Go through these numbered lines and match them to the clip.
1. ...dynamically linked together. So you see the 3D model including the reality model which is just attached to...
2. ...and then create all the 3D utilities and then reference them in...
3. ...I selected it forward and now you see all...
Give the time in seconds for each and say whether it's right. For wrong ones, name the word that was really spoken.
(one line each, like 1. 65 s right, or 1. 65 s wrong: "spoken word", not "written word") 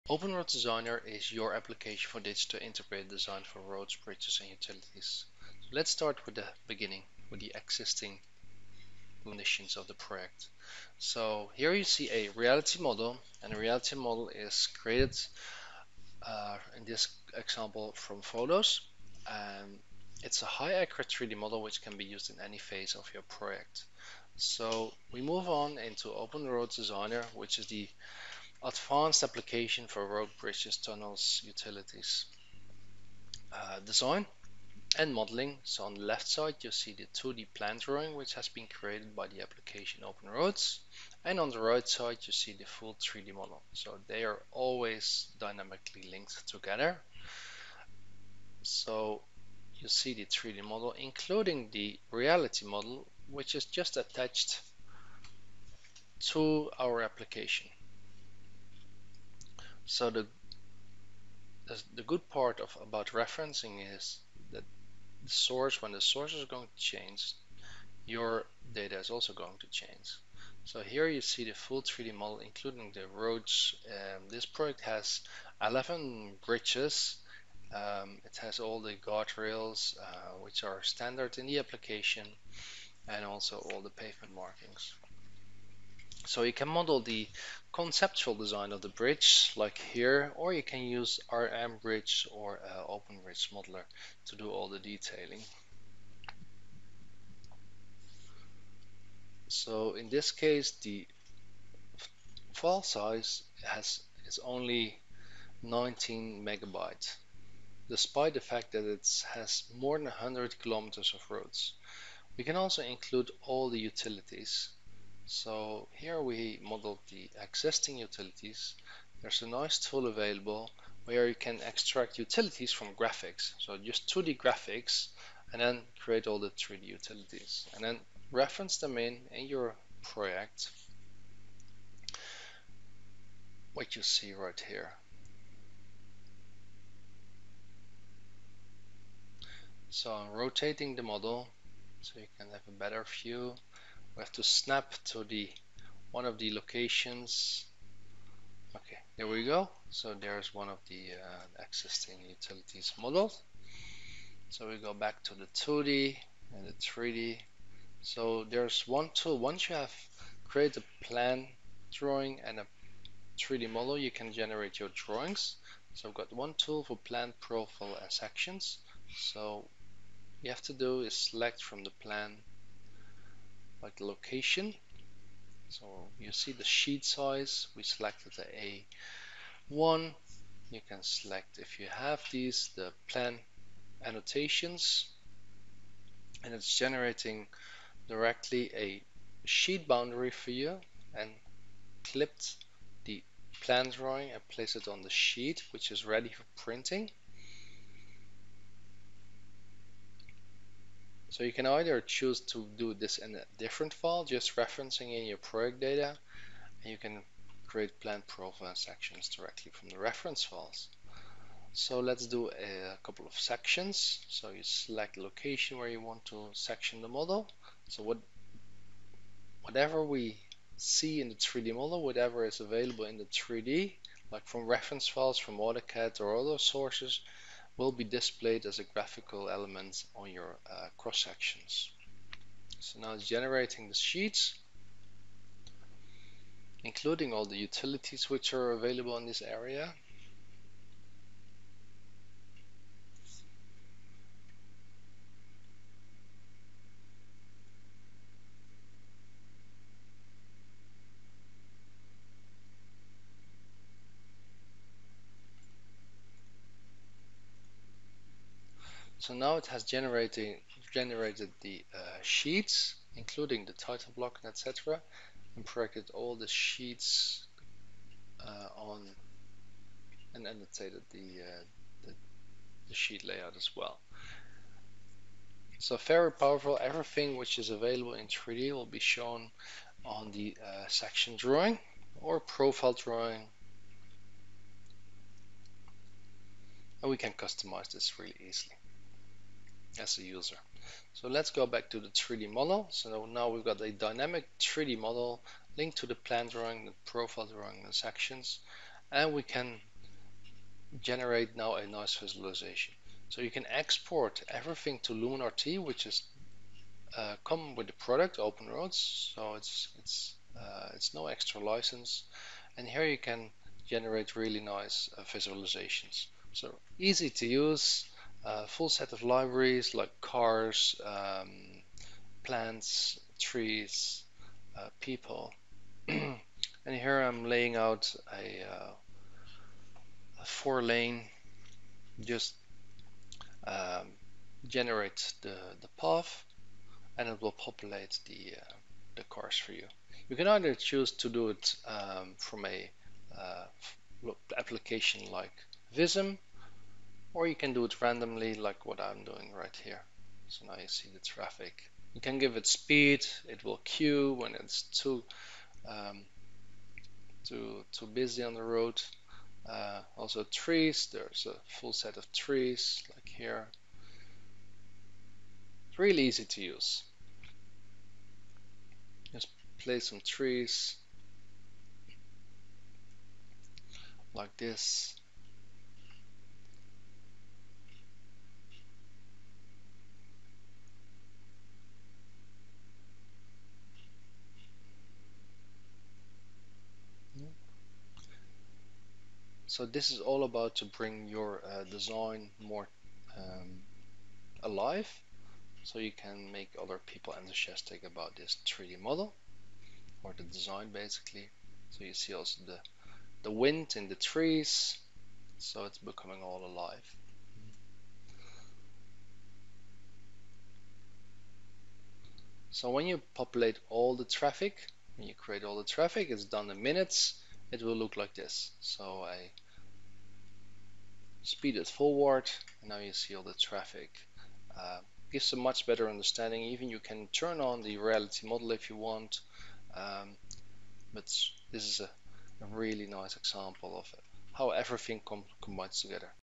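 1. 45 s right
2. 125 s right
3. 419 s wrong: "speed", not "selected".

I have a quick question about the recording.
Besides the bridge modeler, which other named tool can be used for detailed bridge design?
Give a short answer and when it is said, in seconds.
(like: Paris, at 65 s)
RM Bridge, at 91 s.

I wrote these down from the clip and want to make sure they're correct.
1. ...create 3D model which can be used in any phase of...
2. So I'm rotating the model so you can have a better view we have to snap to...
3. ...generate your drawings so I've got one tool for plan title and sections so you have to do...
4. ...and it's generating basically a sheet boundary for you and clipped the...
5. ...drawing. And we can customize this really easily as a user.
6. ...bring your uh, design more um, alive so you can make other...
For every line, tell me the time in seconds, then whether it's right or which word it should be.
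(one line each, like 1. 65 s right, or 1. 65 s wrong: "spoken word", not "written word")
1. 20 s wrong: "accurate", not "create"
2. 139 s right
3. 164 s wrong: "profile", not "title"
4. 186 s wrong: "directly", not "basically"
5. 282 s right
6. 390 s right.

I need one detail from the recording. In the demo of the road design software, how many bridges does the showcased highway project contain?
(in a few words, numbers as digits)
11.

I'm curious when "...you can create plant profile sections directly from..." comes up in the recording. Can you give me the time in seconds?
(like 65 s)
206 s.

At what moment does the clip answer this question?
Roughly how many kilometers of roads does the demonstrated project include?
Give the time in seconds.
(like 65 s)
109 s.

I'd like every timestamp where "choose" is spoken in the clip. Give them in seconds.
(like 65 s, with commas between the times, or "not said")
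202 s, 340 s.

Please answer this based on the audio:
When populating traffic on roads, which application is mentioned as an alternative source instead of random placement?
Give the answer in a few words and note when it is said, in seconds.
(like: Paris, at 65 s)
Vism, at 345 s.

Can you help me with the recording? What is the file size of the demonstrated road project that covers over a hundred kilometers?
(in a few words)
19 megabytes.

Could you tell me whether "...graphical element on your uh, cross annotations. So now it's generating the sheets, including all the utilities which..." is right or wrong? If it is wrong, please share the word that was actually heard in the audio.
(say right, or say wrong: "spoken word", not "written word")
wrong: "sections", not "annotations".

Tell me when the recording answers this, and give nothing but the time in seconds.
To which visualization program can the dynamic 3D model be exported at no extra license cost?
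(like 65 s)
305 s.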